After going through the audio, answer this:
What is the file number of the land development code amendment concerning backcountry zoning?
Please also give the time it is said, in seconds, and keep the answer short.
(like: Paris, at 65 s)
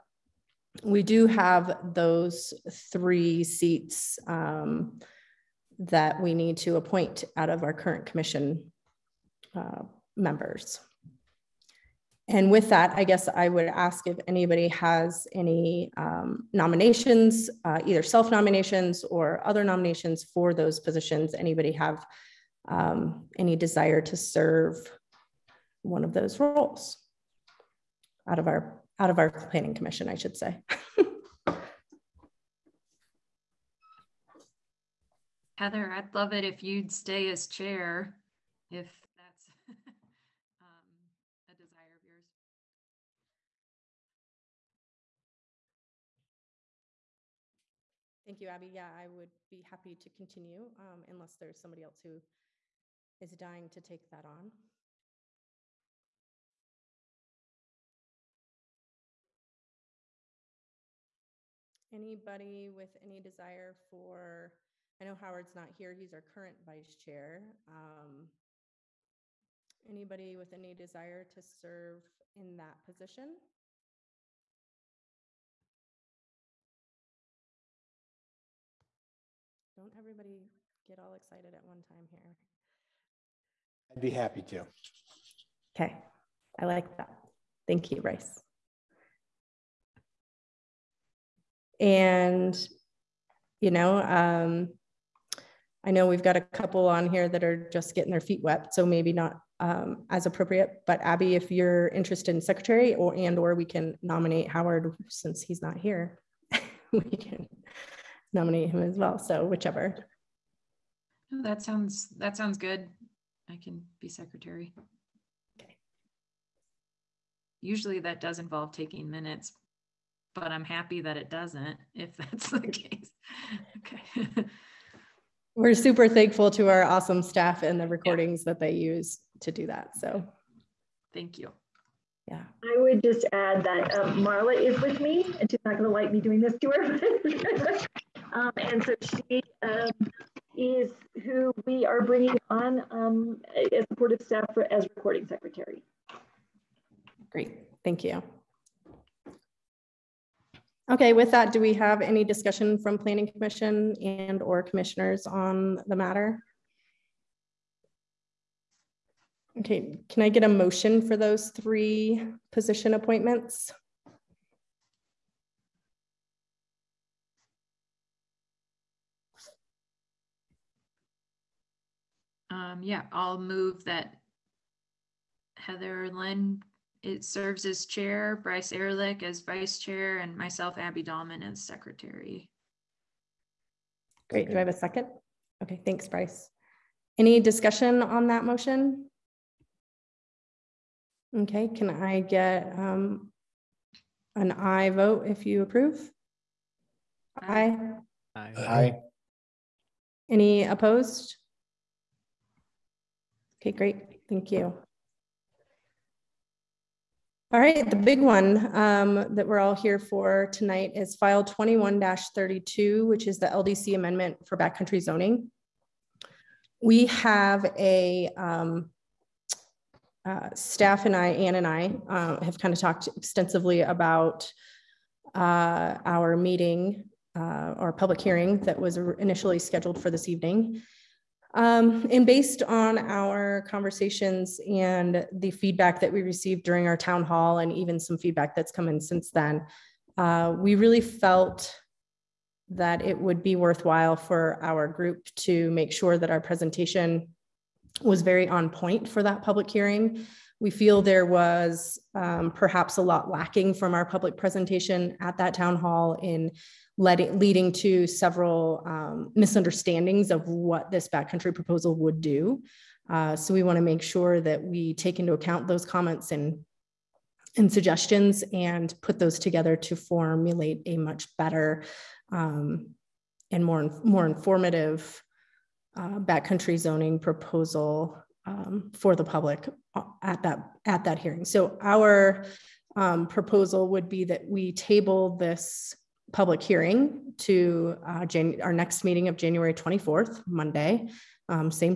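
21-32, at 211 s.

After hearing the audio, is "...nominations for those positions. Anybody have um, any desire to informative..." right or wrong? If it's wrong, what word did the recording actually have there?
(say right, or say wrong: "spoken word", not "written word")
wrong: "serve", not "informative".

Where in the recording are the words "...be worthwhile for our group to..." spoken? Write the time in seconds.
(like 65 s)
243 s.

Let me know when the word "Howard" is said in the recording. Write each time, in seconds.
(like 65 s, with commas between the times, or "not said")
65 s, 104 s.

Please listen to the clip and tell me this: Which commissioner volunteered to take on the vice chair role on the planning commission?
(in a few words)
Bryce Ehrlich.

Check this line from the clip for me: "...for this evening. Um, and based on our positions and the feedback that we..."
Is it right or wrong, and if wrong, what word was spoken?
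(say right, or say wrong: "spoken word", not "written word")
wrong: "conversations", not "positions".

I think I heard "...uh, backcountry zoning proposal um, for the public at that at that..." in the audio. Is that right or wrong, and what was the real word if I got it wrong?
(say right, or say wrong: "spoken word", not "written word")
right.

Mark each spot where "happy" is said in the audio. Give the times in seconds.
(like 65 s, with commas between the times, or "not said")
49 s, 84 s, 120 s.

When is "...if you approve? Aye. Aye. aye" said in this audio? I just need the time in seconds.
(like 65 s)
195 s.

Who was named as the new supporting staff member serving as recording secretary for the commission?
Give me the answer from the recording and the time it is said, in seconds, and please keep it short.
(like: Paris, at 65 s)
Marla, at 134 s.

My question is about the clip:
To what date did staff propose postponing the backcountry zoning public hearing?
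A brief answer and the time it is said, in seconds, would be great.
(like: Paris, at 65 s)
January 24th, at 289 s.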